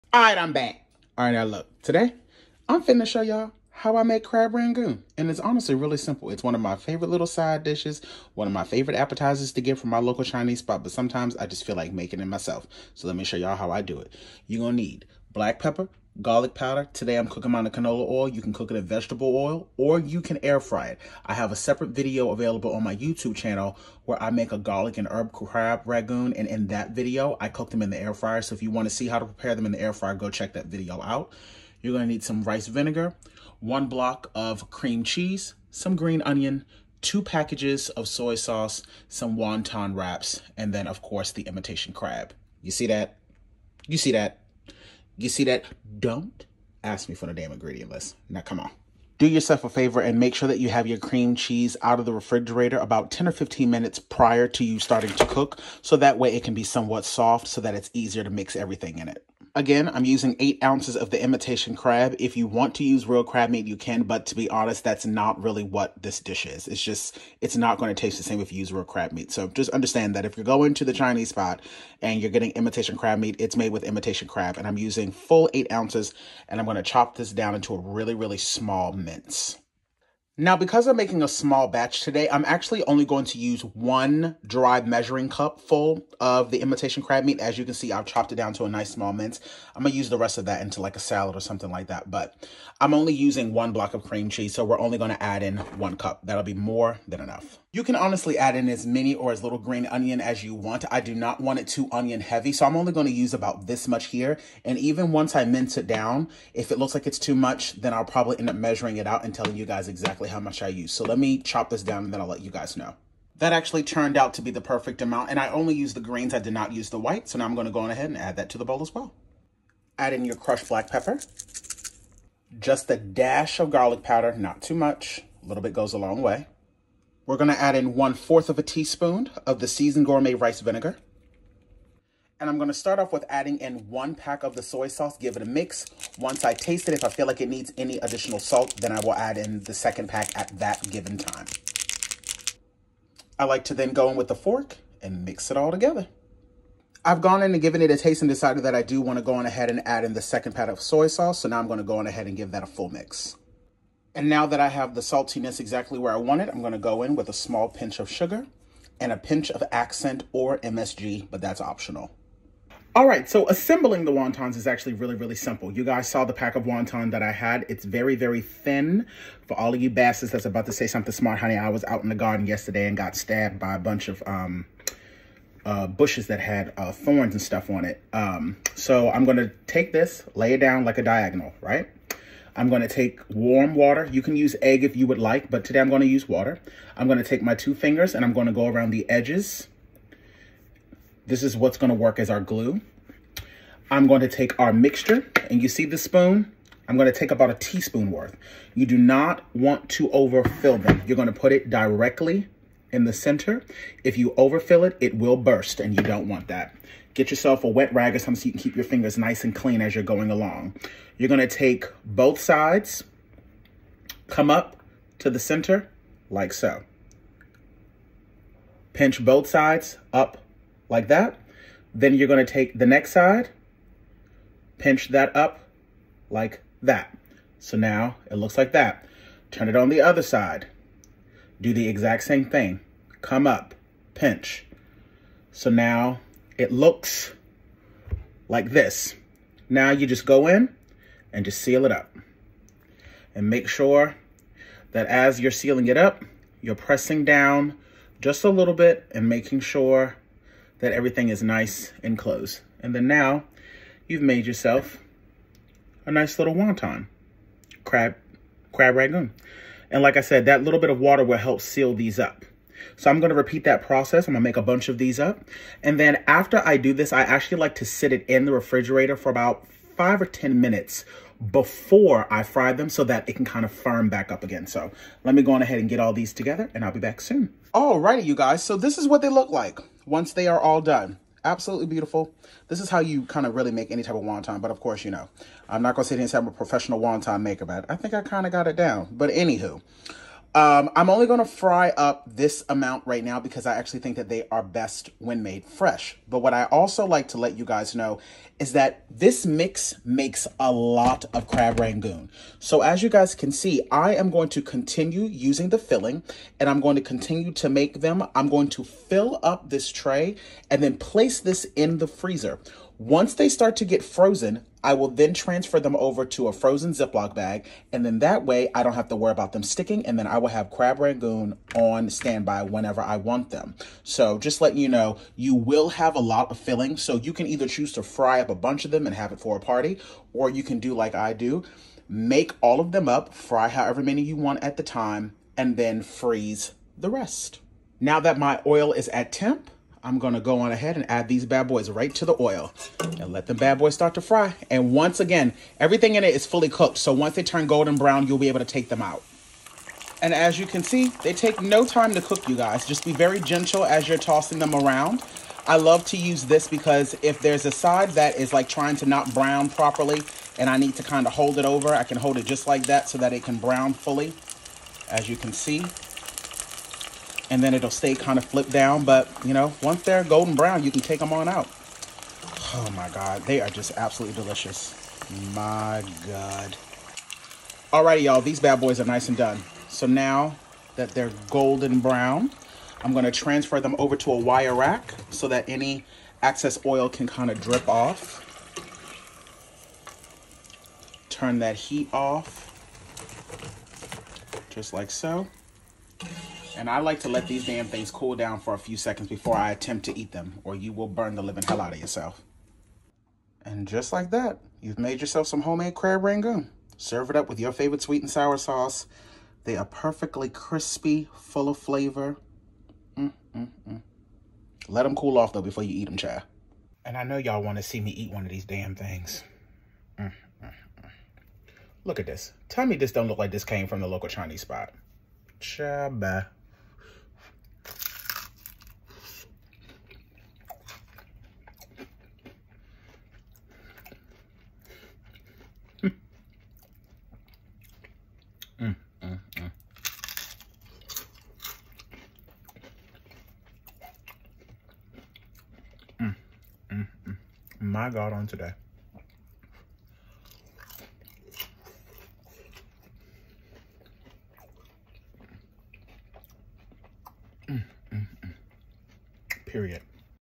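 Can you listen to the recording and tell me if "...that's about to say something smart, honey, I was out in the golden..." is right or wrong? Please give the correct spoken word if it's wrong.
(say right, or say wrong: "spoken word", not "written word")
wrong: "garden", not "golden".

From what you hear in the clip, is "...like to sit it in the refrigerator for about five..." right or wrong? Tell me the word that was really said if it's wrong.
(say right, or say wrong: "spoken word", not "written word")
right.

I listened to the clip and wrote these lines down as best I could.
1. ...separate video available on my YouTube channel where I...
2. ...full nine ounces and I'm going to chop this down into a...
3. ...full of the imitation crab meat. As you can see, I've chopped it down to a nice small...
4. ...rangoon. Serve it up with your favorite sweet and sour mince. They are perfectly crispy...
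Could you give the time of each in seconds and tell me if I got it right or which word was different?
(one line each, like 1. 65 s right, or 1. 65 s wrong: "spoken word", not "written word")
1. 21 s right
2. 75 s wrong: "eight", not "nine"
3. 85 s right
4. 406 s wrong: "sauce", not "mince".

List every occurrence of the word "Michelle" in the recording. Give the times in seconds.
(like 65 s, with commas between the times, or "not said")
not said.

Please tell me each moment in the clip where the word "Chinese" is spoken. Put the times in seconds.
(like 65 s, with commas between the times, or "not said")
10 s, 70 s, 424 s.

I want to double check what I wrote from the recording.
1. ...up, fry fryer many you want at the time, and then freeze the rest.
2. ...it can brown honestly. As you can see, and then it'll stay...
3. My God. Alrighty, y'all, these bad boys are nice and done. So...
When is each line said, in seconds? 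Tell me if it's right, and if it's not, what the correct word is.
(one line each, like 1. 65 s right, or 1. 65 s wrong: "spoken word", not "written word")
1. 333 s wrong: "however", not "fryer"
2. 363 s wrong: "fully", not "honestly"
3. 375 s right.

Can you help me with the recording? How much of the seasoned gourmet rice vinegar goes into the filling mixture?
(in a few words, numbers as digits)
1/4 teaspoon.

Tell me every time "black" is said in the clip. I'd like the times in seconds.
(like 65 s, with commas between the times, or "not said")
15 s, 120 s.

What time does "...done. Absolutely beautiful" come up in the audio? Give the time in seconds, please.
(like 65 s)
280 s.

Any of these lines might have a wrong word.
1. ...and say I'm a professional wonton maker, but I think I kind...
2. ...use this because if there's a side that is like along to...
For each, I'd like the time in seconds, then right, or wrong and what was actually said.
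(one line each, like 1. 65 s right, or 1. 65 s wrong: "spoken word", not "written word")
1. 286 s right
2. 356 s wrong: "trying", not "along".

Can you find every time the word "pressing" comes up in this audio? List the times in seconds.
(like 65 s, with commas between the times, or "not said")
246 s.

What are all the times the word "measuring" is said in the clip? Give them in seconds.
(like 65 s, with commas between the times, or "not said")
84 s, 108 s.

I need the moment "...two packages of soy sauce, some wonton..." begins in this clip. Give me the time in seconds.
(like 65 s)
37 s.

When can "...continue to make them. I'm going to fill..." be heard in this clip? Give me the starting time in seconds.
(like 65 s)
307 s.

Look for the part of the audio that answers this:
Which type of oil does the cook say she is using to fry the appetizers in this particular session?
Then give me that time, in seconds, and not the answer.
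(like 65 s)
17 s.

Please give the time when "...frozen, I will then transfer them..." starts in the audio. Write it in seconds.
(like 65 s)
314 s.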